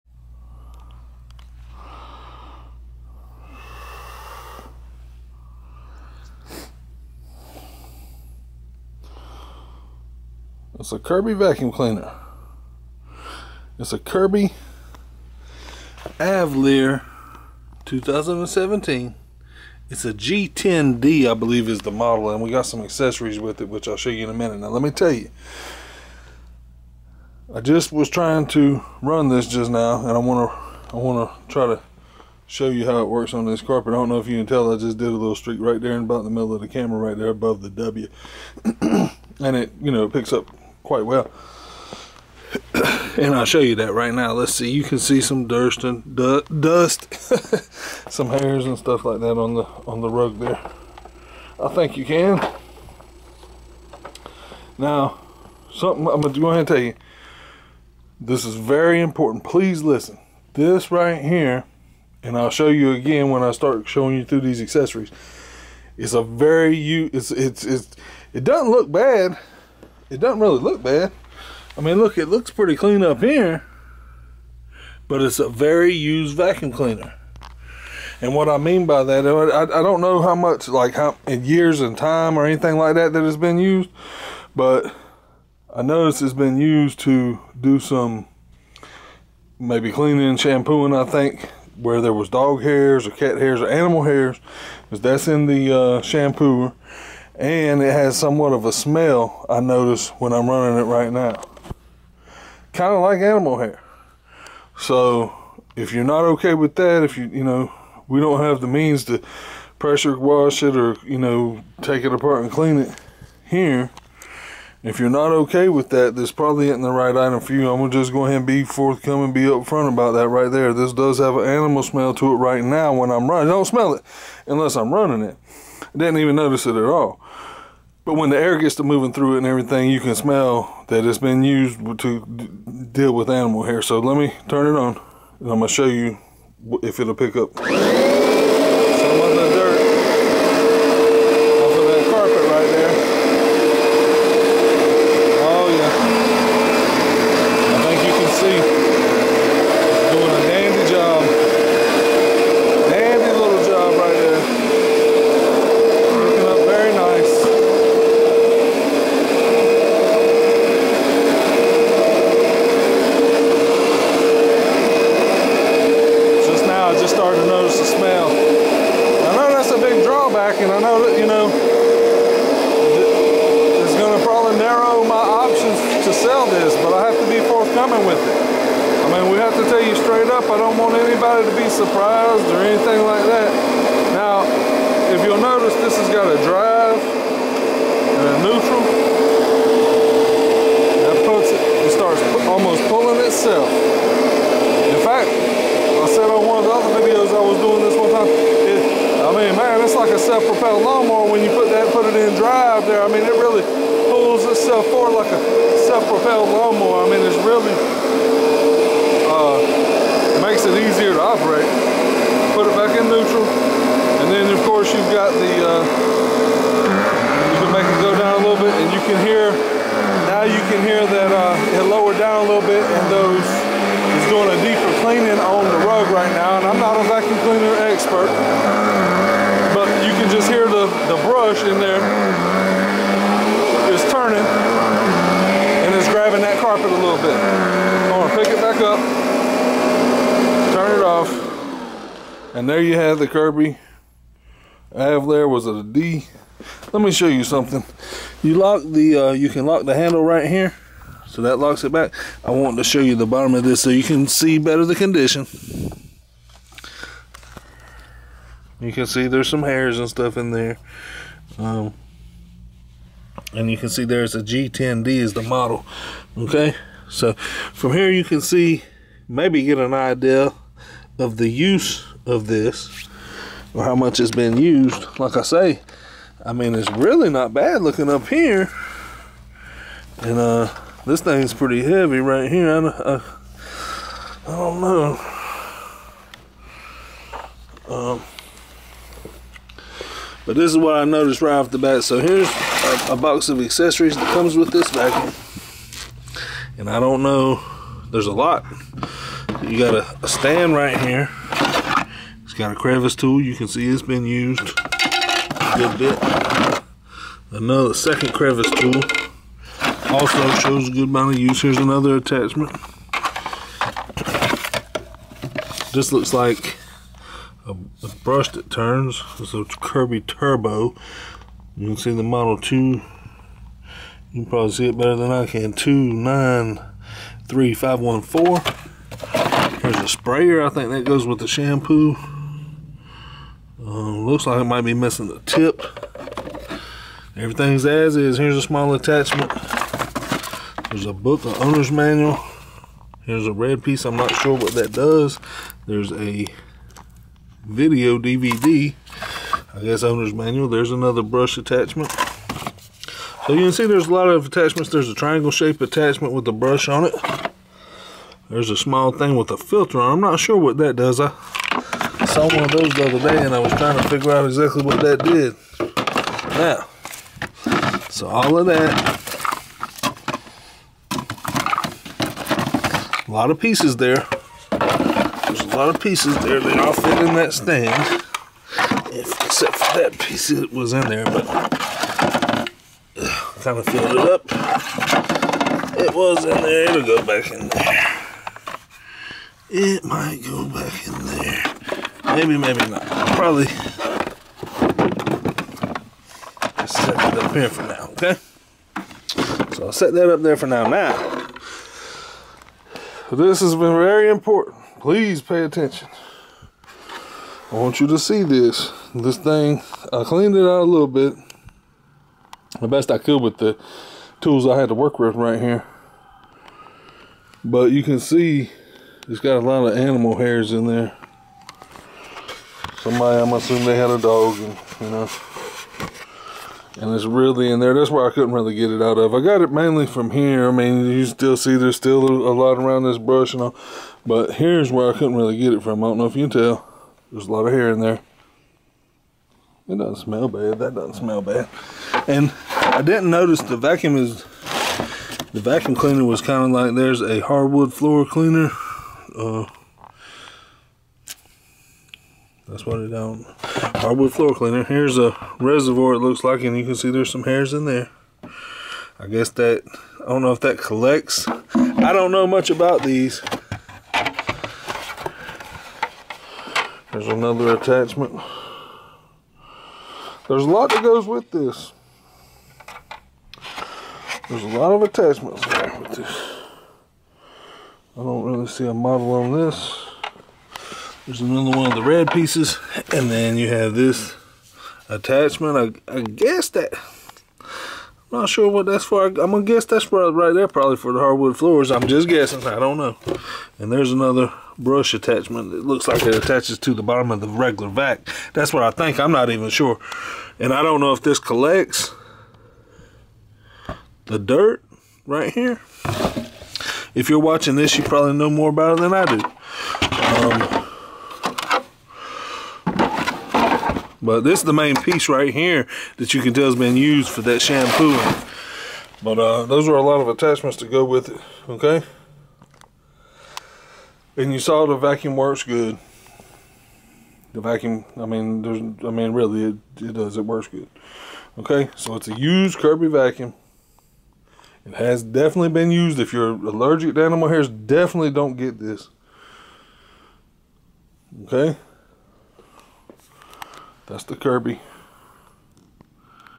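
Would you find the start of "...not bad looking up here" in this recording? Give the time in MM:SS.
04:37.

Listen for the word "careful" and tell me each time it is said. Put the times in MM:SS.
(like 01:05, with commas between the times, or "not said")
not said.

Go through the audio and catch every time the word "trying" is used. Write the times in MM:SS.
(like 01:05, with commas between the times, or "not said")
00:28, 06:03.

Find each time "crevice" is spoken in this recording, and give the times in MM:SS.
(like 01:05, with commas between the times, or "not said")
05:02, 05:08.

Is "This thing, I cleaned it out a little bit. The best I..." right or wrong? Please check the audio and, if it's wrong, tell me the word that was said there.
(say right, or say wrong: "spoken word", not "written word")
right.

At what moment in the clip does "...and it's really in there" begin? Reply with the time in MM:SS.
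07:06.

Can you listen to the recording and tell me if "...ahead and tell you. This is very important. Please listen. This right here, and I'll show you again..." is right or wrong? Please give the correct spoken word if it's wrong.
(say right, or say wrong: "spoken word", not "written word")
right.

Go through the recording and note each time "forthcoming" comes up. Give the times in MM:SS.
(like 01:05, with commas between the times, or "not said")
01:58, 02:57.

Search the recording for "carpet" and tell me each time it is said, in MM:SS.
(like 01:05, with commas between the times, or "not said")
00:33, 03:56.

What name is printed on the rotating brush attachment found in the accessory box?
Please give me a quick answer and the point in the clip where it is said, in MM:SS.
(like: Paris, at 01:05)
Kirby Turbo, at 05:19.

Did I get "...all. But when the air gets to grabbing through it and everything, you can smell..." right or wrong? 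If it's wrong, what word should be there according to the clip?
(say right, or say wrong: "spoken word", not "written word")
wrong: "moving", not "grabbing".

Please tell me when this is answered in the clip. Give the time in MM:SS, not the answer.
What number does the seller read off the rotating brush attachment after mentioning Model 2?
05:25.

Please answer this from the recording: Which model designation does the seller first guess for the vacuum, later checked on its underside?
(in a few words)
G10D.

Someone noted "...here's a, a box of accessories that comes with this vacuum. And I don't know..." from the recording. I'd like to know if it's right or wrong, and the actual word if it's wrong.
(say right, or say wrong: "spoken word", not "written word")
right.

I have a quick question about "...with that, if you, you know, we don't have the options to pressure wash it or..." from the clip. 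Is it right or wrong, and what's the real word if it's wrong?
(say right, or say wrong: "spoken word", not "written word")
wrong: "means", not "options".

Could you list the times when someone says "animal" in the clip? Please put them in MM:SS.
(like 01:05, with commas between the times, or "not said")
01:33, 01:43, 02:01, 02:13, 06:59, 08:57.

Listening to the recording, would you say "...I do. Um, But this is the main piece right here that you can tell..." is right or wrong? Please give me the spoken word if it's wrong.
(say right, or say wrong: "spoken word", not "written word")
right.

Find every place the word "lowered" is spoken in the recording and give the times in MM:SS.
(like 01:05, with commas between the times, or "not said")
03:41.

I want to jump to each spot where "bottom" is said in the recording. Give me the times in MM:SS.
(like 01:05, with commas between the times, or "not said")
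04:13, 08:17.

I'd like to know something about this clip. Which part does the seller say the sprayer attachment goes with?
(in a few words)
The shampoo.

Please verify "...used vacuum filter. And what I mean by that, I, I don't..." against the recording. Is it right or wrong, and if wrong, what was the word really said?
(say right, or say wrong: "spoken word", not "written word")
wrong: "cleaner", not "filter".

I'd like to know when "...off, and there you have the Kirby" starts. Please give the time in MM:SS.
04:01.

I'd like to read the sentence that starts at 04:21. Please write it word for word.
Um, and you can see there's a G10D is the model.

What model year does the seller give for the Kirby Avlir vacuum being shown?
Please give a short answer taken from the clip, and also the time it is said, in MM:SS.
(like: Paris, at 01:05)
2017, at 00:17.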